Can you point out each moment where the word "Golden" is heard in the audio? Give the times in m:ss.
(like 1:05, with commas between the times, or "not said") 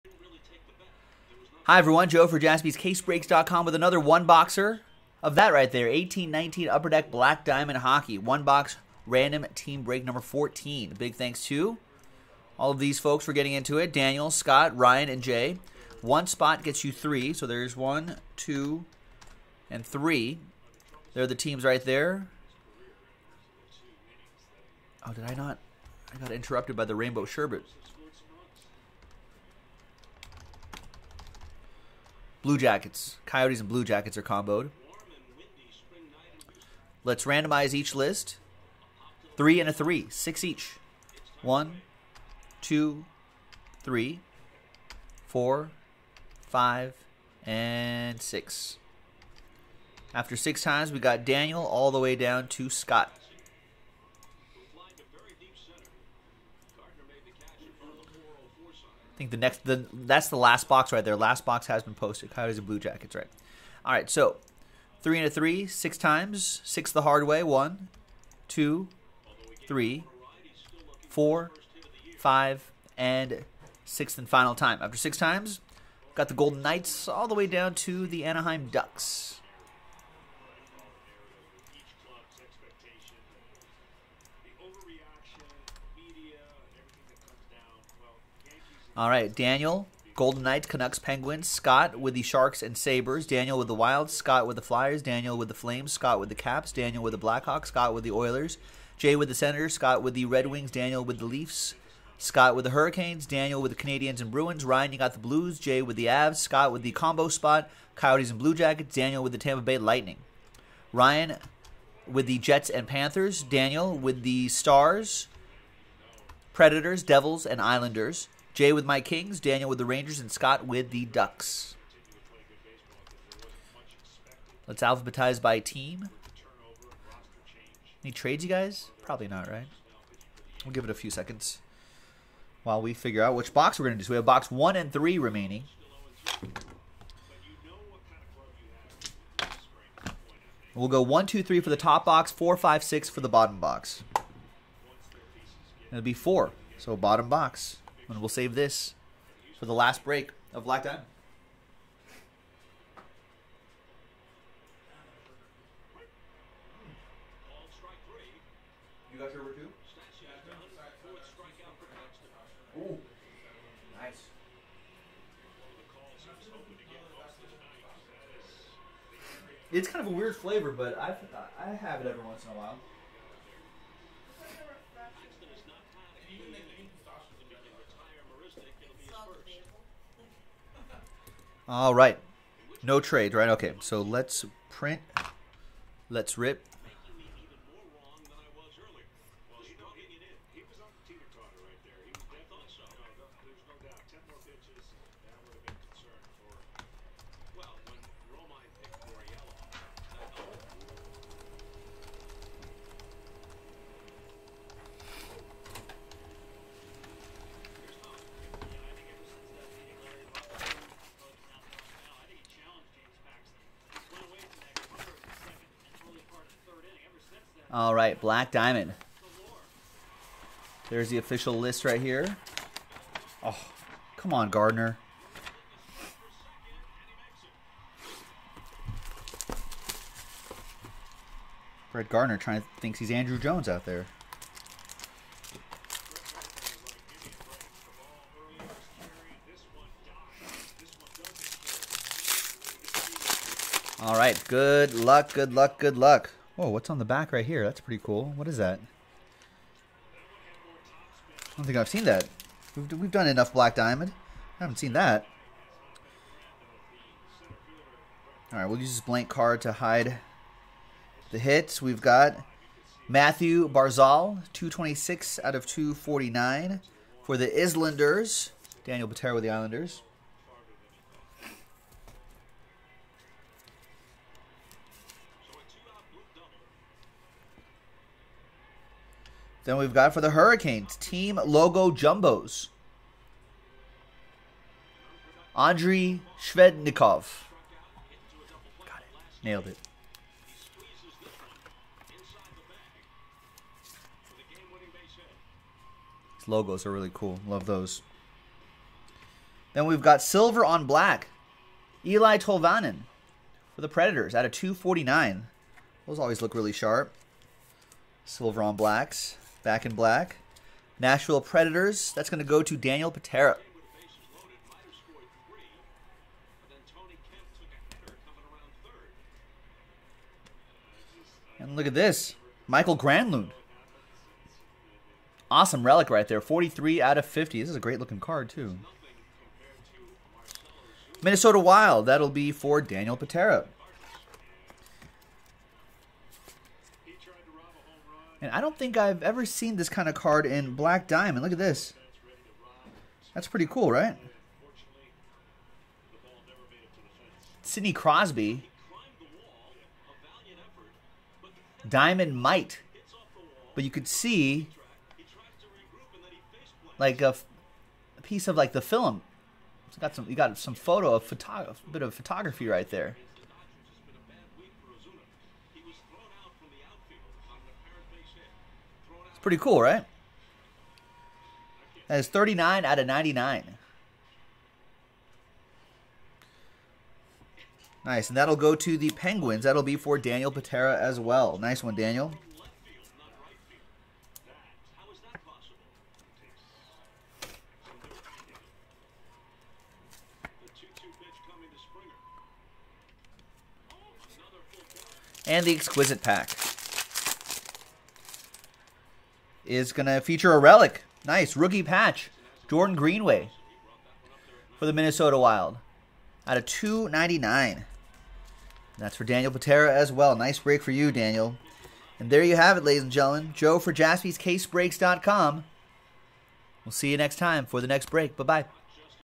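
1:16, 1:30.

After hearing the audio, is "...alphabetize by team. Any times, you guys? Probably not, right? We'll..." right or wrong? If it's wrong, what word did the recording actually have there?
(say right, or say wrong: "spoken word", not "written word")
wrong: "trades", not "times".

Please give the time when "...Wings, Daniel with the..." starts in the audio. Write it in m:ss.
1:40.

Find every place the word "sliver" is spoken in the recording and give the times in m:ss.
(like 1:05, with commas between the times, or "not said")
not said.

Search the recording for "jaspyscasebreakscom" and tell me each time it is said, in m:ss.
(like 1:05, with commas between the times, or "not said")
0:02, 6:53.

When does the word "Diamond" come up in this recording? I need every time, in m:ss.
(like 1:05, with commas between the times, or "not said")
0:07, 2:30, 3:38, 4:13, 5:41, 5:51.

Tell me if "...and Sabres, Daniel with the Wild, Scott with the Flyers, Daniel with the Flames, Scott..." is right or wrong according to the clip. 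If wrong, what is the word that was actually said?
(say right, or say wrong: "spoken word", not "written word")
right.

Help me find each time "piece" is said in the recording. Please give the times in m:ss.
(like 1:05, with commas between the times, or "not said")
5:58.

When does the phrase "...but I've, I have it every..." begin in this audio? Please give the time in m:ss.
2:50.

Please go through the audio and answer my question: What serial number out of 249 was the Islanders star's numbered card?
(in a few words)
226.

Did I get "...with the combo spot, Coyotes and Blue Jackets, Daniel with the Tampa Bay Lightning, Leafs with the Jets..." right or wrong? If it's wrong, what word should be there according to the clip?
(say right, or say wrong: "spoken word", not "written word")
wrong: "Ryan", not "Leafs".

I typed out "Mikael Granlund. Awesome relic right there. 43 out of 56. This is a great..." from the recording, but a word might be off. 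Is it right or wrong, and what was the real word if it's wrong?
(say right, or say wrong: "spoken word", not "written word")
wrong: "50", not "56".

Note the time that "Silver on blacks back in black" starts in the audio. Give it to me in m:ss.
5:08.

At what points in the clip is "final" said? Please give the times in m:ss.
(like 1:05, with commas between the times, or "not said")
1:14.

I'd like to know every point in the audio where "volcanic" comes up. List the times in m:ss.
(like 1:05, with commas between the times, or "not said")
not said.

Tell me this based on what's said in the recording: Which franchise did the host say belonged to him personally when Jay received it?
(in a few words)
Kings.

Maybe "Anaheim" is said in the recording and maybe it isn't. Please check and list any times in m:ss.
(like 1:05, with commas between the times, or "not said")
1:18.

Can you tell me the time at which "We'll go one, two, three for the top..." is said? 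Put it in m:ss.
2:20.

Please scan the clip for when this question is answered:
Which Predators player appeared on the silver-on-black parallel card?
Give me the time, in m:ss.
5:02.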